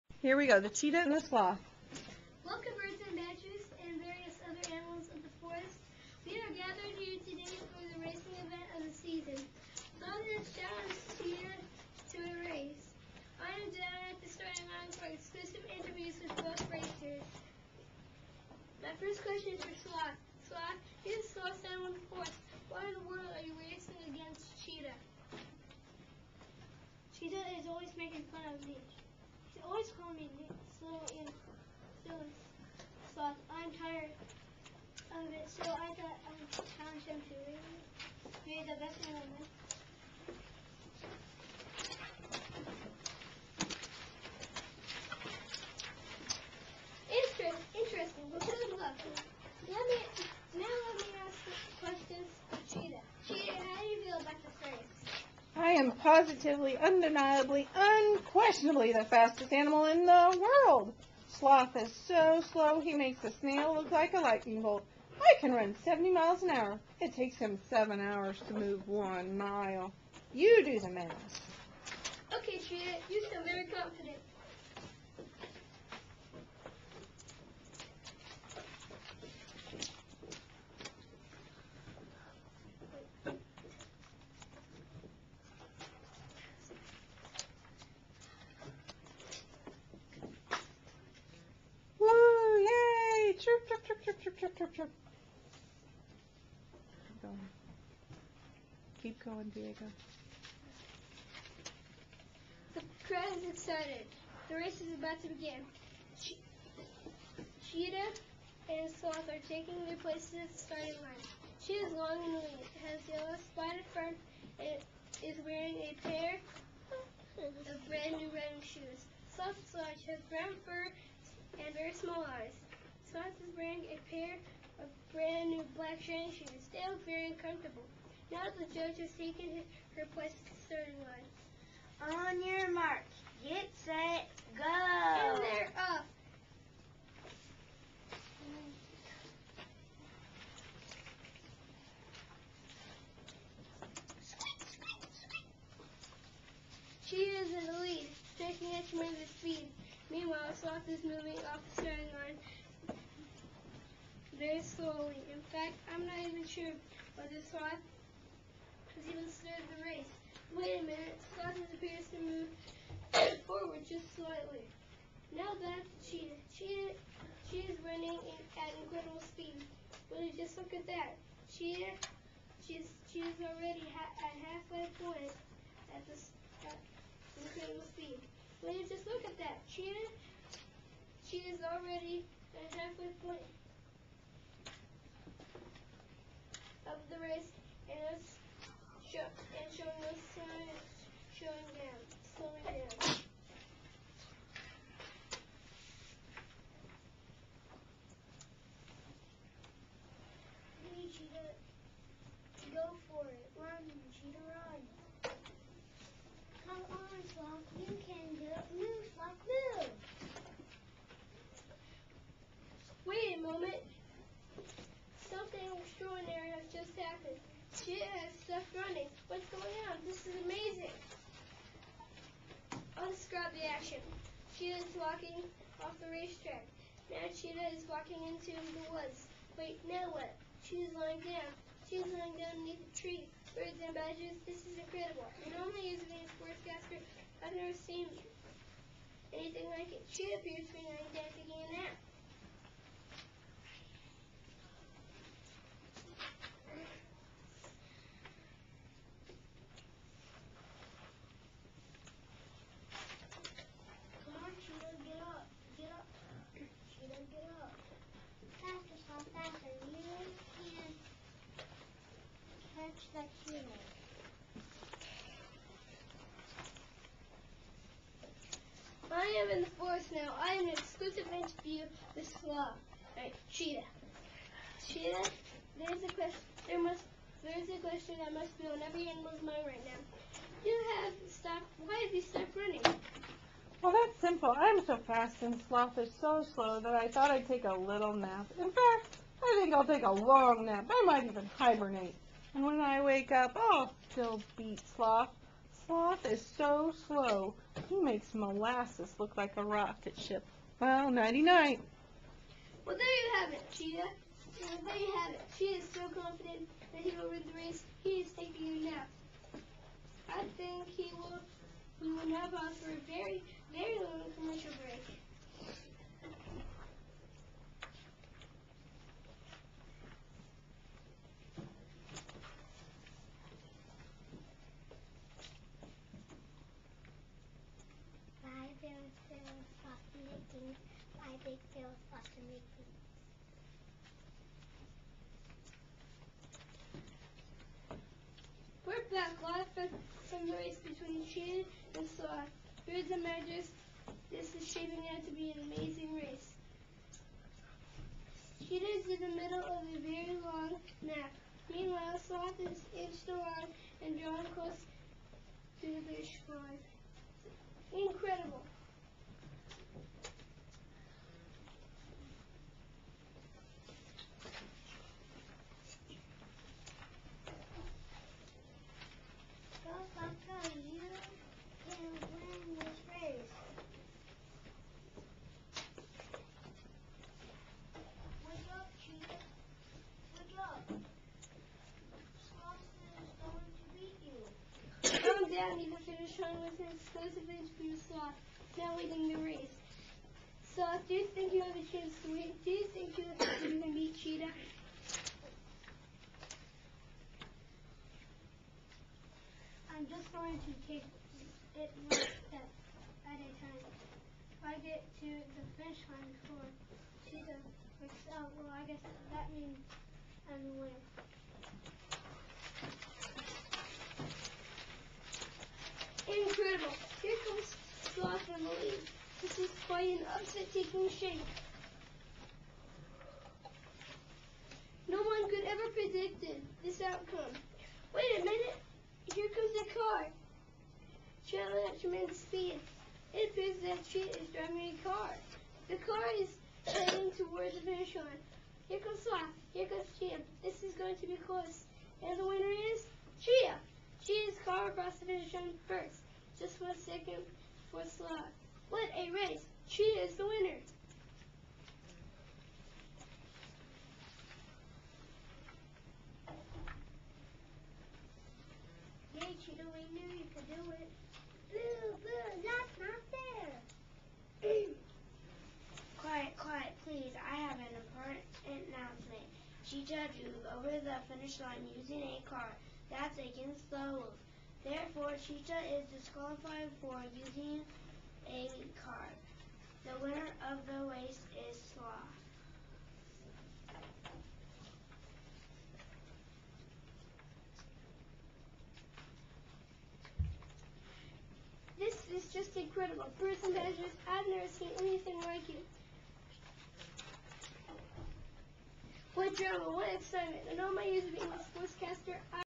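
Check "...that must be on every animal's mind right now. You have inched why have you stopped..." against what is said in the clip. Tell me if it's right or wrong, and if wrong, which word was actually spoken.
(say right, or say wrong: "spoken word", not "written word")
wrong: "stopped", not "inched".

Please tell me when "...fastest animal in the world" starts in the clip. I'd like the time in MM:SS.
00:59.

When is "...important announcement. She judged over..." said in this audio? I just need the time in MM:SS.
07:48.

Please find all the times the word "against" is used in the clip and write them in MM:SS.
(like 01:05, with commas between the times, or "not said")
00:24, 07:53.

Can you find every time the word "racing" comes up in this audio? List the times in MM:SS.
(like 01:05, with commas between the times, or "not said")
00:08, 00:23.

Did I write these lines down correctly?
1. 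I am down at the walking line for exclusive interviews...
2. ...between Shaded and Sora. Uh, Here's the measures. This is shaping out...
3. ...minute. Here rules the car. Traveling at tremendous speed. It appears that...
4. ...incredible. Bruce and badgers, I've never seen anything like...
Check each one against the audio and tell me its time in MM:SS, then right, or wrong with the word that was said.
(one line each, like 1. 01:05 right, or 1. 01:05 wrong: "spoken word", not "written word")
1. 00:13 wrong: "starting", not "walking"
2. 05:40 right
3. 07:08 wrong: "comes", not "rules"
4. 08:12 right.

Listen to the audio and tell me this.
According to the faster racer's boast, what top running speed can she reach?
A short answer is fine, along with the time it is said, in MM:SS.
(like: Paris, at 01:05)
70 miles an hour, at 01:05.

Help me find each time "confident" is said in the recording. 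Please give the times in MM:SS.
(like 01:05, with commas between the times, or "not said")
01:13, 05:06.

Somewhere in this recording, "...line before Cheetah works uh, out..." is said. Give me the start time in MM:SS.
06:46.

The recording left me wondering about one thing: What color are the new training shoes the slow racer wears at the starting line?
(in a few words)
black.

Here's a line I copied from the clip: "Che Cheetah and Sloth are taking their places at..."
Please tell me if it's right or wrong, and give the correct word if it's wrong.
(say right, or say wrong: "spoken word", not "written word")
right.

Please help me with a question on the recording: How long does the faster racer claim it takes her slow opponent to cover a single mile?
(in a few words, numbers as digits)
7 hours.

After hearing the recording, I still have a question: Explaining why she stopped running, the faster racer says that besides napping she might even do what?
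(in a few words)
hibernate.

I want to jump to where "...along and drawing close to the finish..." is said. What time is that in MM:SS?
05:53.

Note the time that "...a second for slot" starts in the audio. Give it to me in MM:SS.
07:26.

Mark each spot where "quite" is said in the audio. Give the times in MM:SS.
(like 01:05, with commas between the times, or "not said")
06:59.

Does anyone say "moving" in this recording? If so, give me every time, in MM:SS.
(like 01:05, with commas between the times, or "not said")
02:31.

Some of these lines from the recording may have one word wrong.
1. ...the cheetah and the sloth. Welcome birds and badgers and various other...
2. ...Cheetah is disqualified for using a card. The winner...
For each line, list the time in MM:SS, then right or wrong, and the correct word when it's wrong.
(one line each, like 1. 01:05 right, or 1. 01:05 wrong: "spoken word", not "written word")
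1. 00:00 right
2. 07:55 right.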